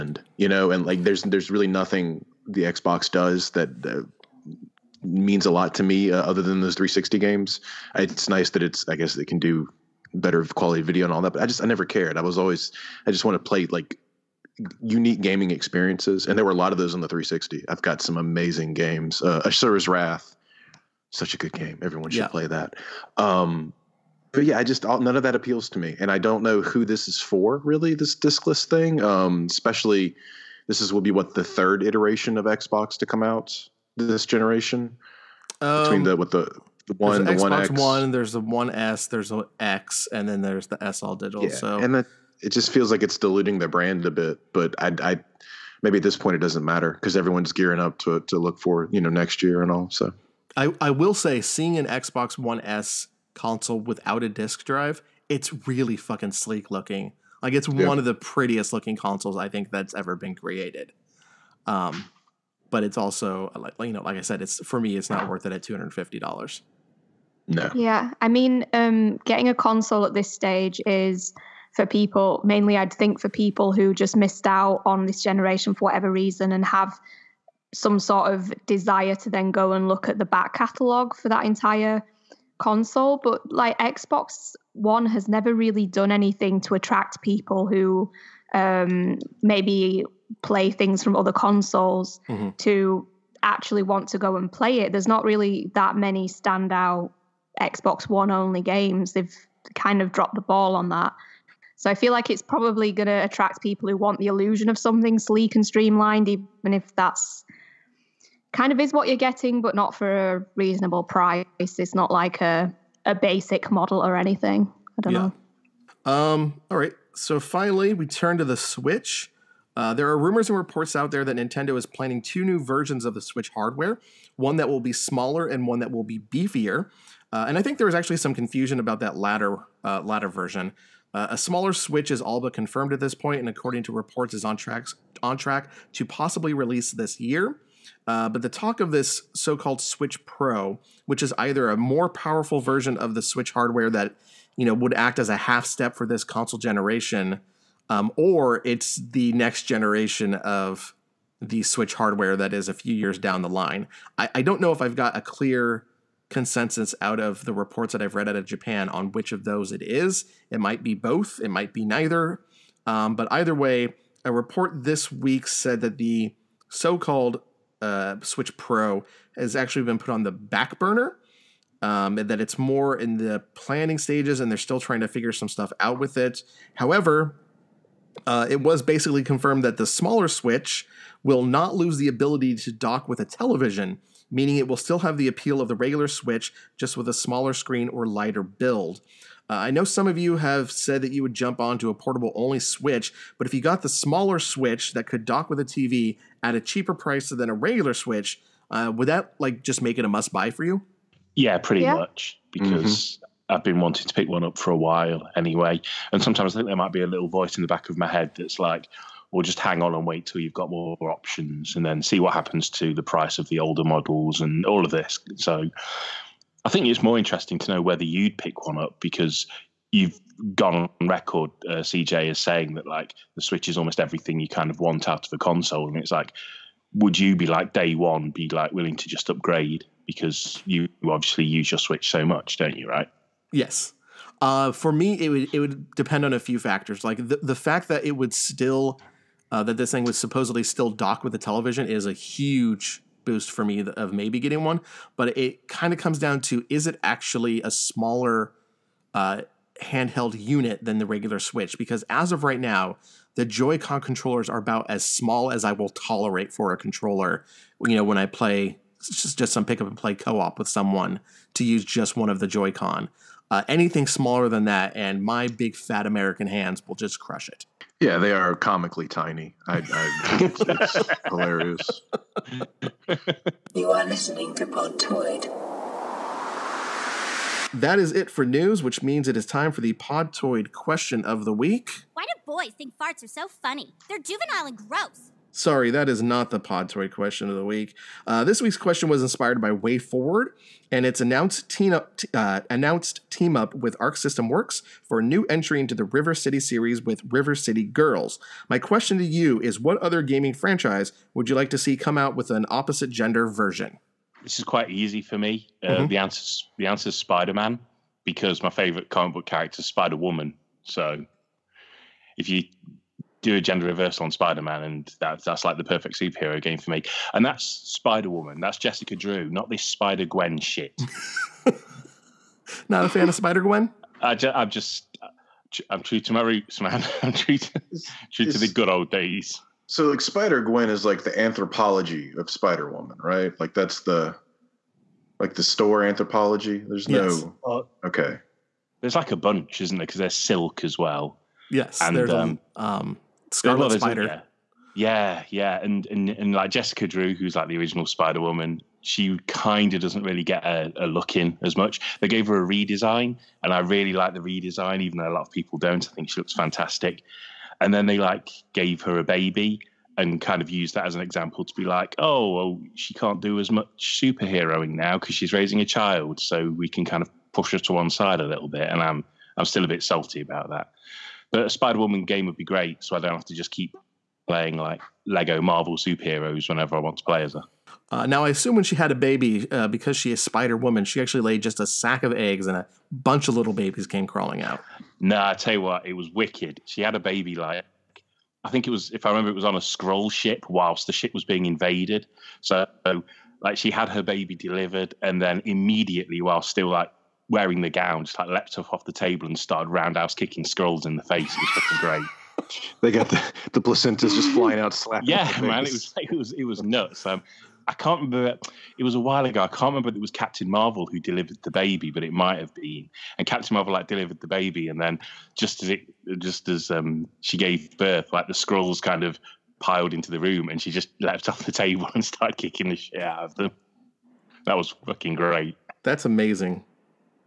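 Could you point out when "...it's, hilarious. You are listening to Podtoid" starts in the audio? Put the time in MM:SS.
04:30.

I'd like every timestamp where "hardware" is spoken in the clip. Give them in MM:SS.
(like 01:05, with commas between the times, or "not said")
02:03, 02:23, 02:31.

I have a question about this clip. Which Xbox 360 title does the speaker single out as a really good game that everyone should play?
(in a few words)
Asura's Wrath.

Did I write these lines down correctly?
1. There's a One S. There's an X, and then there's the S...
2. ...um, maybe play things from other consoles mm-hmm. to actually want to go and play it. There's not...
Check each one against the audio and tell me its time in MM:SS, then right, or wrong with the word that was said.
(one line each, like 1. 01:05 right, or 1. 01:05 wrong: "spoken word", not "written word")
1. 00:38 right
2. 01:28 right.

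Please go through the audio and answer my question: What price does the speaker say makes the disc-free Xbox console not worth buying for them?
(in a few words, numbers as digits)
$250.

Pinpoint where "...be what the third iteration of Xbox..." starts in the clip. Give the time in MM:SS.
00:31.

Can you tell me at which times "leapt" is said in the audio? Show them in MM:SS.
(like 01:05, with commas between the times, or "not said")
06:38, 07:01.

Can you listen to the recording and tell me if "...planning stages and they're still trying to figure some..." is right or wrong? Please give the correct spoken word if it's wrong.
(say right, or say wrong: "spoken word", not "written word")
right.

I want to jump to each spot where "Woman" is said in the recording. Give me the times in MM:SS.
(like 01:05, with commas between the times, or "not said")
05:10, 05:17, 05:32, 05:48, 06:11, 06:20.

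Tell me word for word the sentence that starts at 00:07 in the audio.
It's nice that it's I guess it can do better quality video and all that.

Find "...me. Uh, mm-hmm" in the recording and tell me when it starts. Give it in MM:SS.
05:05.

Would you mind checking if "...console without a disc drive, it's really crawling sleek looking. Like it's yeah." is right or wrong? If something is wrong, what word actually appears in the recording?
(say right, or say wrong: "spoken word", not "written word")
wrong: "fucking", not "crawling".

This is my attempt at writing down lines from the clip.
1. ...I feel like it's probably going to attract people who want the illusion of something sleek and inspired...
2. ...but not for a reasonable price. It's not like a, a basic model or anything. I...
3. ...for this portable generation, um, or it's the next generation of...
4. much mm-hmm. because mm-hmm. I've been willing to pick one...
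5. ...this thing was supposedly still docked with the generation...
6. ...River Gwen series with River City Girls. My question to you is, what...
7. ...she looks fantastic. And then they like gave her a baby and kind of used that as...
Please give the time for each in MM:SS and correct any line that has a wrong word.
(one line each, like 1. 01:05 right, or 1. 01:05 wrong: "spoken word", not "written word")
1. 01:41 wrong: "streamlined", not "inspired"
2. 01:49 right
3. 02:25 wrong: "console", not "portable"
4. 03:21 wrong: "wanting", not "willing"
5. 03:59 wrong: "television", not "generation"
6. 04:56 wrong: "City", not "Gwen"
7. 05:56 right.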